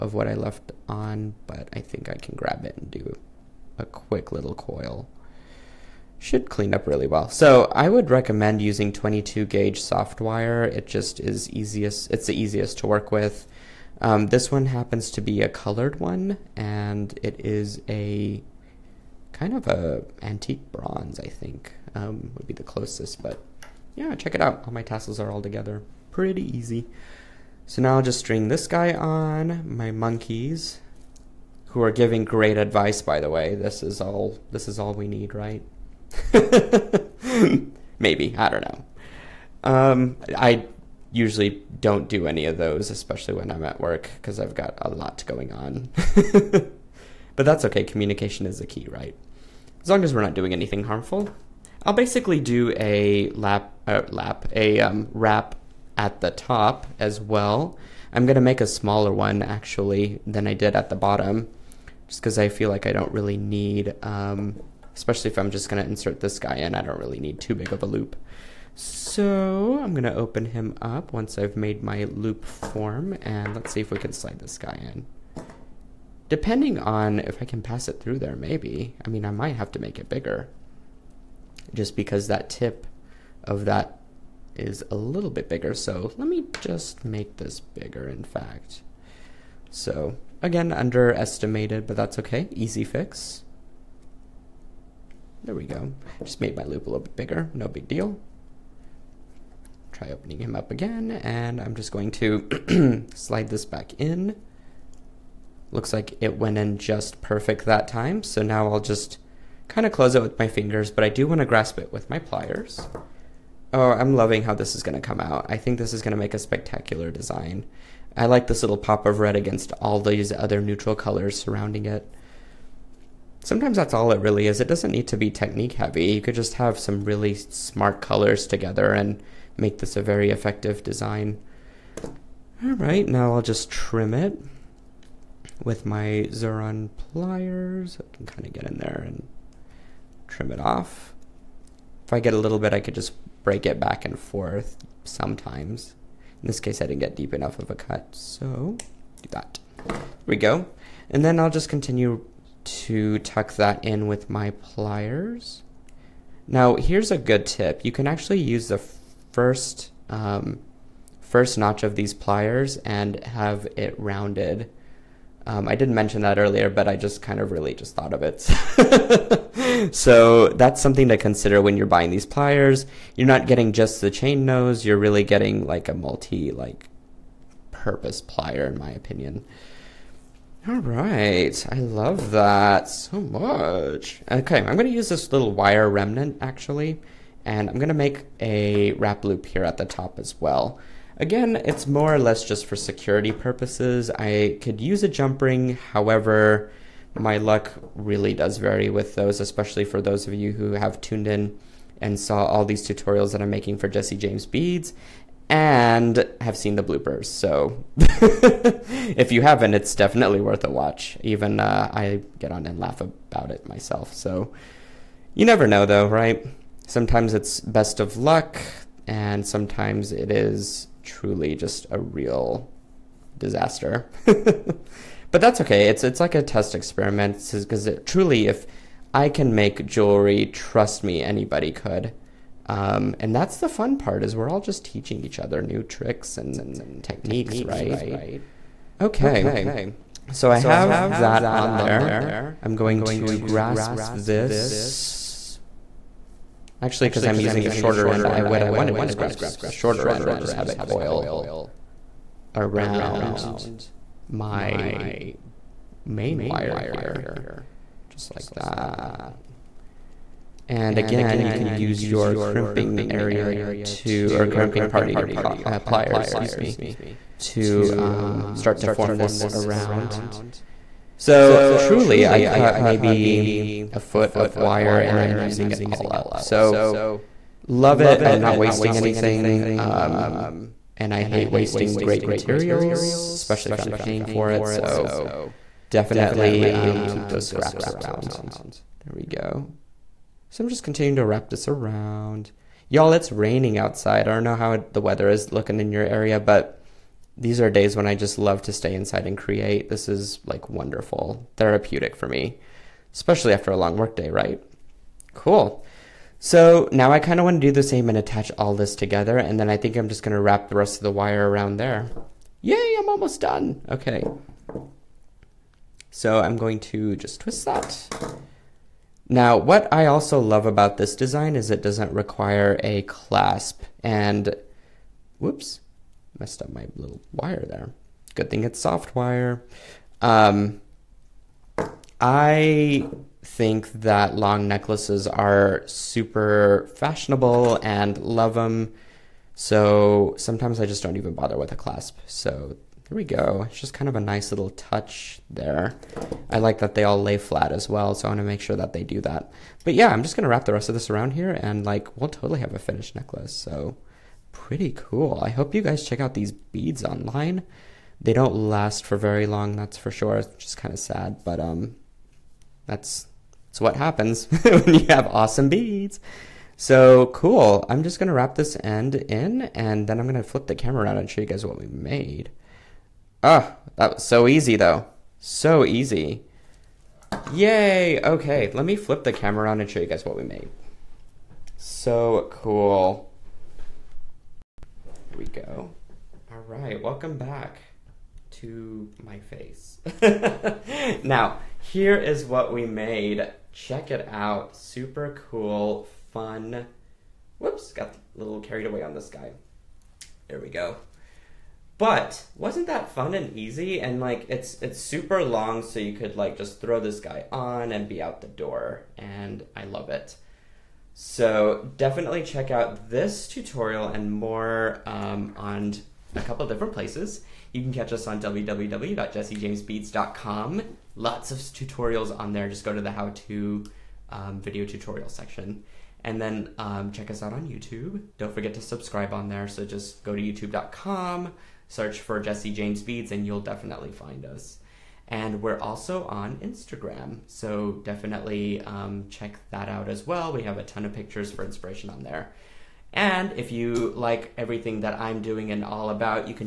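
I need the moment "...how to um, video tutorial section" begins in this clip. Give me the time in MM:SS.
07:03.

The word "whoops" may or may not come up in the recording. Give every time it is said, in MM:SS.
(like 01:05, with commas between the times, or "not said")
05:25, 06:37.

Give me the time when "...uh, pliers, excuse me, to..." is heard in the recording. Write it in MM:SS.
04:25.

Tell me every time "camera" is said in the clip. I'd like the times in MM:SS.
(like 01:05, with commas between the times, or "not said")
06:10, 06:19.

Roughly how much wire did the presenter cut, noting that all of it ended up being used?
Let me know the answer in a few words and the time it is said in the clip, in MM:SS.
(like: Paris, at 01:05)
a foot, at 04:33.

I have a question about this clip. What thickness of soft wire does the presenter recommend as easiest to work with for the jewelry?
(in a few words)
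22 gauge.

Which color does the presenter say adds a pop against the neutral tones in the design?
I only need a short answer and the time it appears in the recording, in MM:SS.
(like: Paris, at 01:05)
red, at 01:59.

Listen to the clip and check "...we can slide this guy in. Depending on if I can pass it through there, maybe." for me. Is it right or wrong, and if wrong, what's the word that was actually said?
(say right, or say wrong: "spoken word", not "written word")
right.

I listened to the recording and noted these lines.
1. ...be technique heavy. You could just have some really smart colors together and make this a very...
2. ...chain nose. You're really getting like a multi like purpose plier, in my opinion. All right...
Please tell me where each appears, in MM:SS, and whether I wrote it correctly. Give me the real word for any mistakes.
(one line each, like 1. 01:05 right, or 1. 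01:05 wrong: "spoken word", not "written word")
1. 02:05 right
2. 02:54 right.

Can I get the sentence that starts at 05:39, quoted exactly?
So sometimes I just don't even bother with a clasp.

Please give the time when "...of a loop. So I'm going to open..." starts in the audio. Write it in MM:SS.
01:07.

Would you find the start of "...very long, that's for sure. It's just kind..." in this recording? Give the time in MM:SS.
05:59.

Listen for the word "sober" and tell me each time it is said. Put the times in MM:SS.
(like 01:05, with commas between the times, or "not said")
not said.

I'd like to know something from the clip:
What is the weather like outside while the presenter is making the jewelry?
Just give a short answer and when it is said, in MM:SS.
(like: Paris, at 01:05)
raining, at 04:53.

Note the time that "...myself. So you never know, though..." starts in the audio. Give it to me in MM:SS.
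03:33.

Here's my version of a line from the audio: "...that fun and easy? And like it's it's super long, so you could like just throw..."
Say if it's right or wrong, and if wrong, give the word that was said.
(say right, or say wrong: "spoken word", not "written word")
right.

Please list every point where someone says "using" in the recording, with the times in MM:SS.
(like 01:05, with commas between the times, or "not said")
00:08, 04:07, 04:35.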